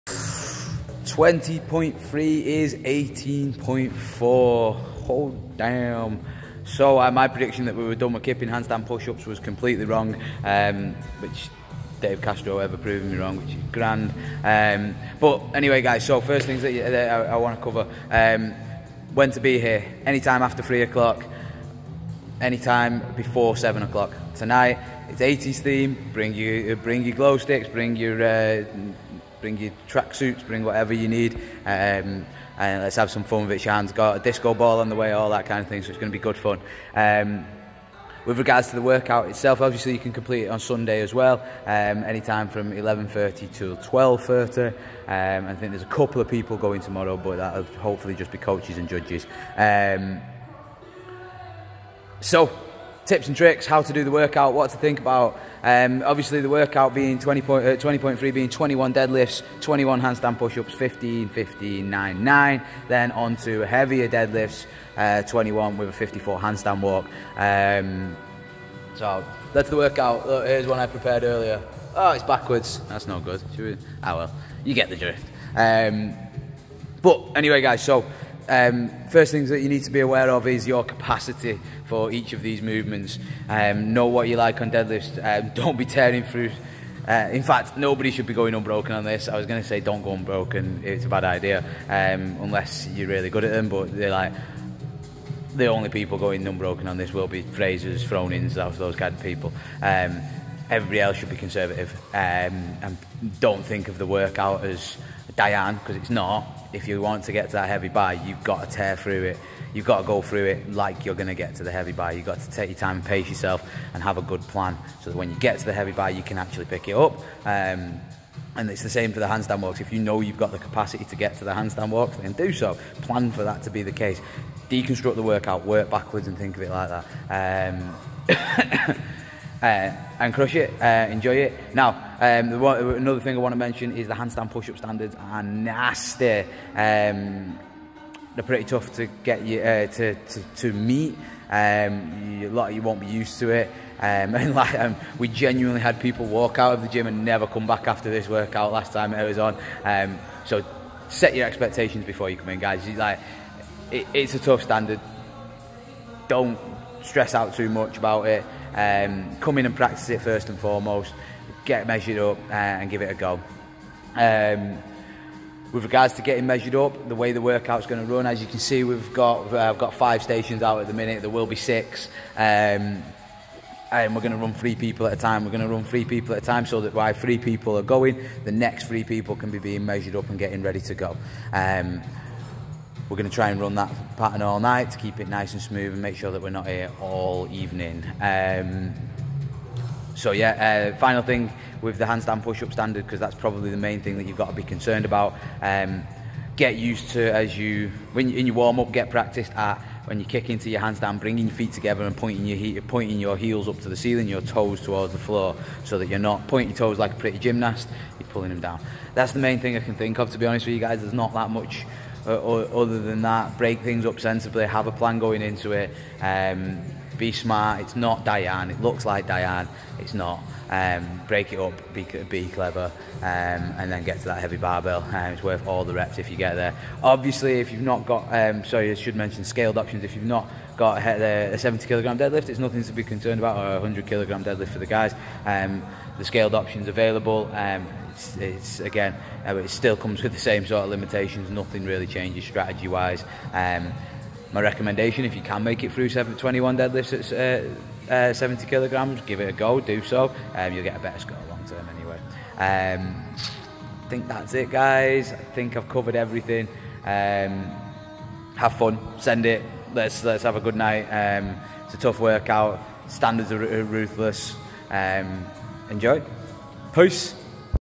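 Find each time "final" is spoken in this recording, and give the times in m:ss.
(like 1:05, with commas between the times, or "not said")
3:10.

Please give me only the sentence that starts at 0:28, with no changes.
Uh, bring your tracksuits, bring whatever you need, um, and let's have some fun with it.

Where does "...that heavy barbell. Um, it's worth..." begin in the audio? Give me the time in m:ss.
3:44.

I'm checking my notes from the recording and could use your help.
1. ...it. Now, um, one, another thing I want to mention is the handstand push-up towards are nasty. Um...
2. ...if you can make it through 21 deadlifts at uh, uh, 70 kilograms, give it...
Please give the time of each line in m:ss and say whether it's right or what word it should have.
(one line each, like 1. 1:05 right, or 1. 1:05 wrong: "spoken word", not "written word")
1. 2:11 wrong: "standards", not "towards"
2. 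4:05 right.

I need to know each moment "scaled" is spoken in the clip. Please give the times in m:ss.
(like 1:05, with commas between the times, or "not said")
3:49, 3:56.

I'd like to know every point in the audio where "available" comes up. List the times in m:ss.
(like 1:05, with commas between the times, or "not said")
3:56.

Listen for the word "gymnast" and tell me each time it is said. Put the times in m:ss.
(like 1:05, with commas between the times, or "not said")
3:27.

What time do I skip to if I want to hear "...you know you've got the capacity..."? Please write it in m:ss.
1:59.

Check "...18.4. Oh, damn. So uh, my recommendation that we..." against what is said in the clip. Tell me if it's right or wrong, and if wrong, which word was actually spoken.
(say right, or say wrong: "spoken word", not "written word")
wrong: "prediction", not "recommendation".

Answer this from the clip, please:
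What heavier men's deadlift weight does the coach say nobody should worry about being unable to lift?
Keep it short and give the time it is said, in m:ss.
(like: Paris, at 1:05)
100 kilograms, at 3:53.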